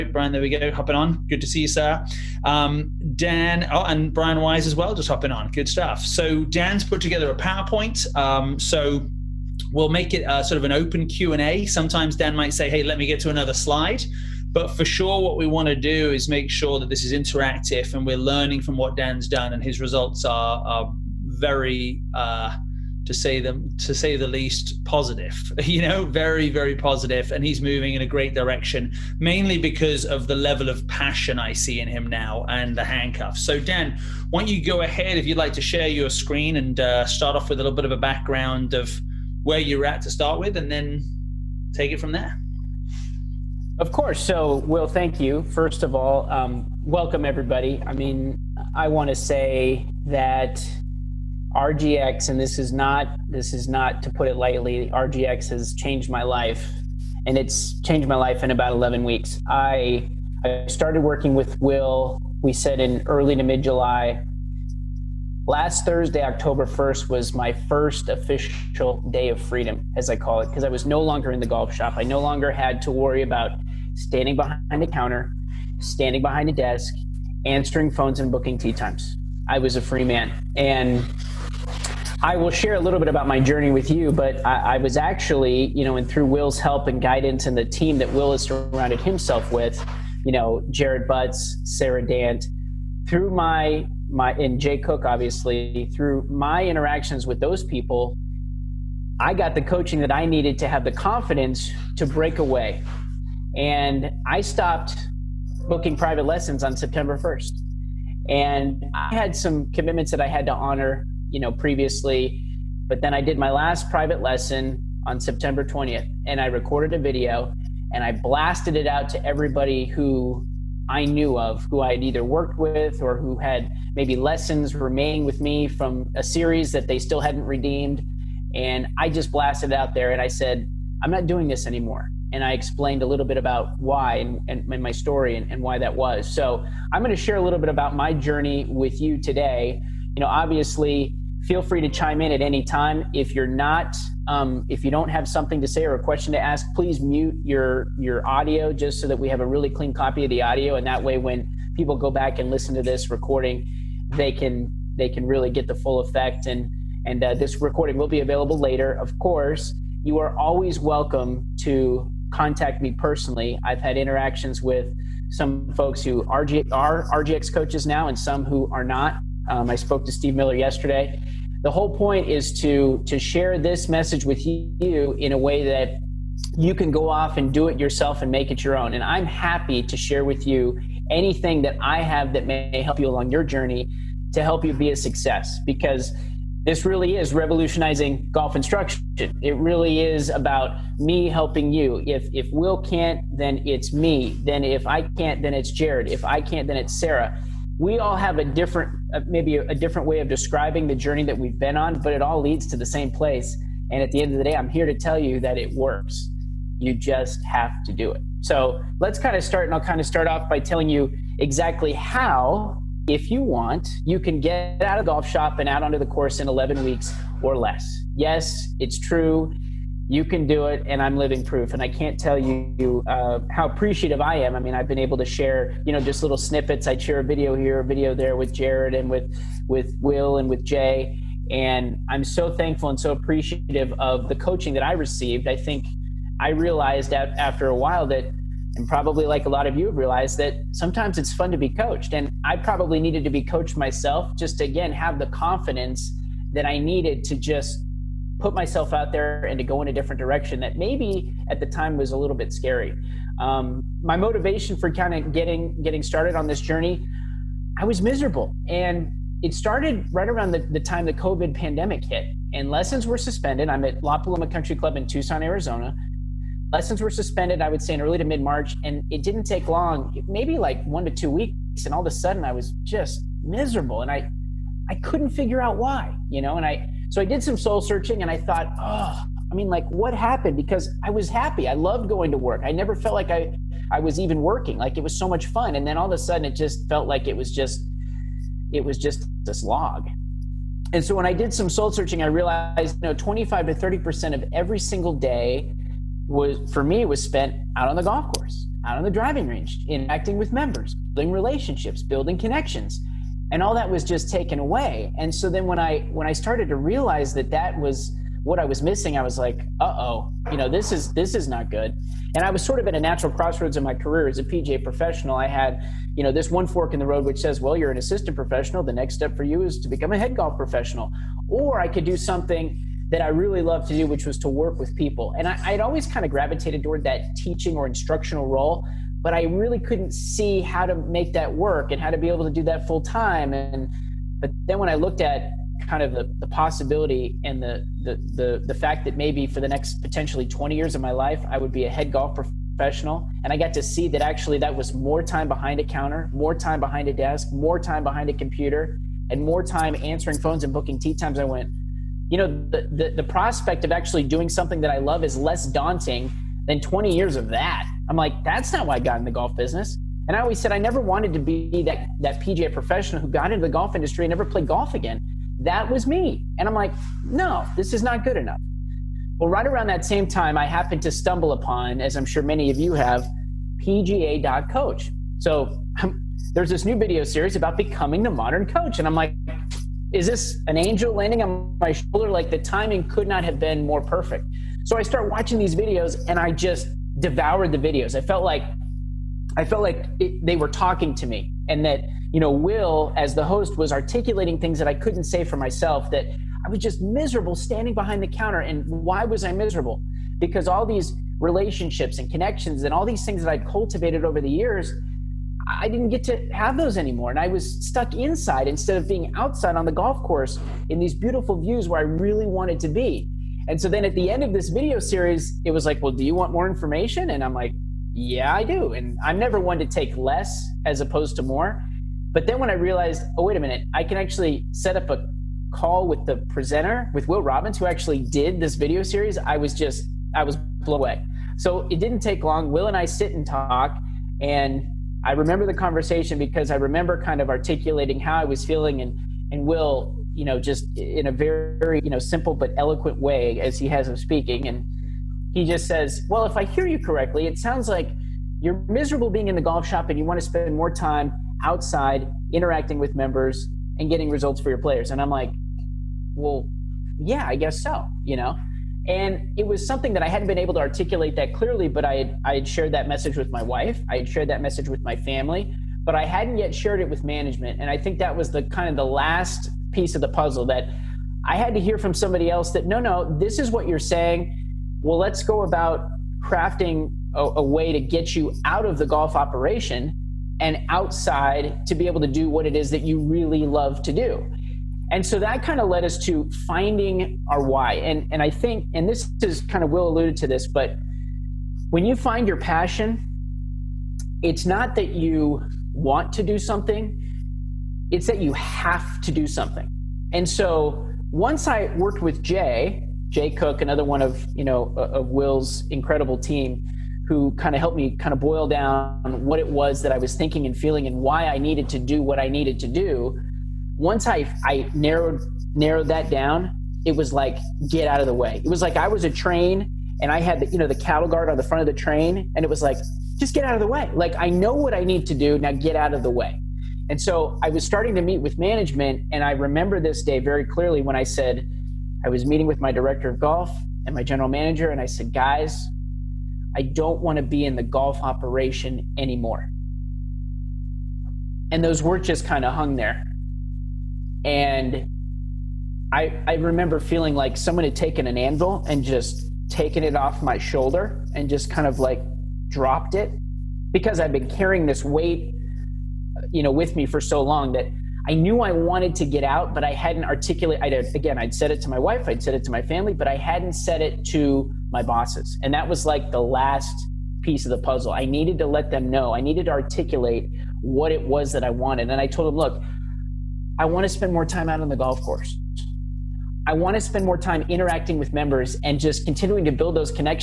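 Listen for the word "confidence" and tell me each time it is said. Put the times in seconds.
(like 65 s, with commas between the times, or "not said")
100 s, 245 s.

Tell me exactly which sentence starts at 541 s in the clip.
And those words just kind of hung there.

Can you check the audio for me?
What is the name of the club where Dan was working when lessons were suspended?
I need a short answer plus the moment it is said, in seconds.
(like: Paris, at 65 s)
La Paloma Country Club, at 264 s.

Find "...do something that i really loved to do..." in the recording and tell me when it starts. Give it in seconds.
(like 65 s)
322 s.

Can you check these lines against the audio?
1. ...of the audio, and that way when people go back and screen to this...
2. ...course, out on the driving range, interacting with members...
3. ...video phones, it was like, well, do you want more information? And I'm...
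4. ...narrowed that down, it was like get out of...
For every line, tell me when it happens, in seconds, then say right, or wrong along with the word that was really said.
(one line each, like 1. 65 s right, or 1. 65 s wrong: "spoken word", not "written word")
1. 150 s wrong: "listen", not "screen"
2. 298 s right
3. 414 s wrong: "series", not "phones"
4. 515 s right.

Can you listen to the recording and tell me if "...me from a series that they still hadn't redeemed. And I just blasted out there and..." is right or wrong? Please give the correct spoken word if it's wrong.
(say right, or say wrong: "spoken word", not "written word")
right.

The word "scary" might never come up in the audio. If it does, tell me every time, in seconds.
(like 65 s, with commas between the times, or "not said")
252 s.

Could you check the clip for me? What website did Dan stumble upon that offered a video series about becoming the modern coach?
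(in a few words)
PGA.coach.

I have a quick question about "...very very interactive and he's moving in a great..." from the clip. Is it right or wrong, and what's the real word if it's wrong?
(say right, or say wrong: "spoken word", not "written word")
wrong: "positive", not "interactive".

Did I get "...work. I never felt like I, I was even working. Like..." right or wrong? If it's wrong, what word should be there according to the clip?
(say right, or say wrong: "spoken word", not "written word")
right.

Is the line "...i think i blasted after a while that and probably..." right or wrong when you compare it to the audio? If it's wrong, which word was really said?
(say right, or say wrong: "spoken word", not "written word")
wrong: "realized", not "blasted".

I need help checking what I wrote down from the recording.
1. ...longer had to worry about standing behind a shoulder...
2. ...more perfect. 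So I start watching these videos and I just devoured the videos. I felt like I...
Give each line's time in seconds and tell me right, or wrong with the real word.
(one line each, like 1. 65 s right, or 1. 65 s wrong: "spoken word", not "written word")
1. 72 s wrong: "counter", not "shoulder"
2. 383 s right.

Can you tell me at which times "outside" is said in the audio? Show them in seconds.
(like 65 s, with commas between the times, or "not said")
409 s, 451 s, 480 s.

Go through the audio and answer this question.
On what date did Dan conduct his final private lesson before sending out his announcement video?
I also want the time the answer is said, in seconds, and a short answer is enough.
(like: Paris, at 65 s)
September 20th, at 115 s.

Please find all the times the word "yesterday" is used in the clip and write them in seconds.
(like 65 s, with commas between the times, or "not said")
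170 s.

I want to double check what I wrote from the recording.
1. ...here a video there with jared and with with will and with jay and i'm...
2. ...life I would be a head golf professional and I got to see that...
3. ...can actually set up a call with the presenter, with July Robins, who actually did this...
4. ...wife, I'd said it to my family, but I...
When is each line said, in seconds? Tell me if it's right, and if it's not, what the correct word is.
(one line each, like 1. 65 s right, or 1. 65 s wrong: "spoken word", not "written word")
1. 227 s right
2. 341 s right
3. 424 s wrong: "Will", not "July"
4. 561 s right.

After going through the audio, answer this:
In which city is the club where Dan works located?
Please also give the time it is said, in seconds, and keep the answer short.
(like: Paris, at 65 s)
Tucson, at 265 s.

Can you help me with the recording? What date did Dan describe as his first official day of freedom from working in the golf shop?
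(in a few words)
October 1st.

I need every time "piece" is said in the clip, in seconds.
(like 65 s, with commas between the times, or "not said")
469 s, 567 s.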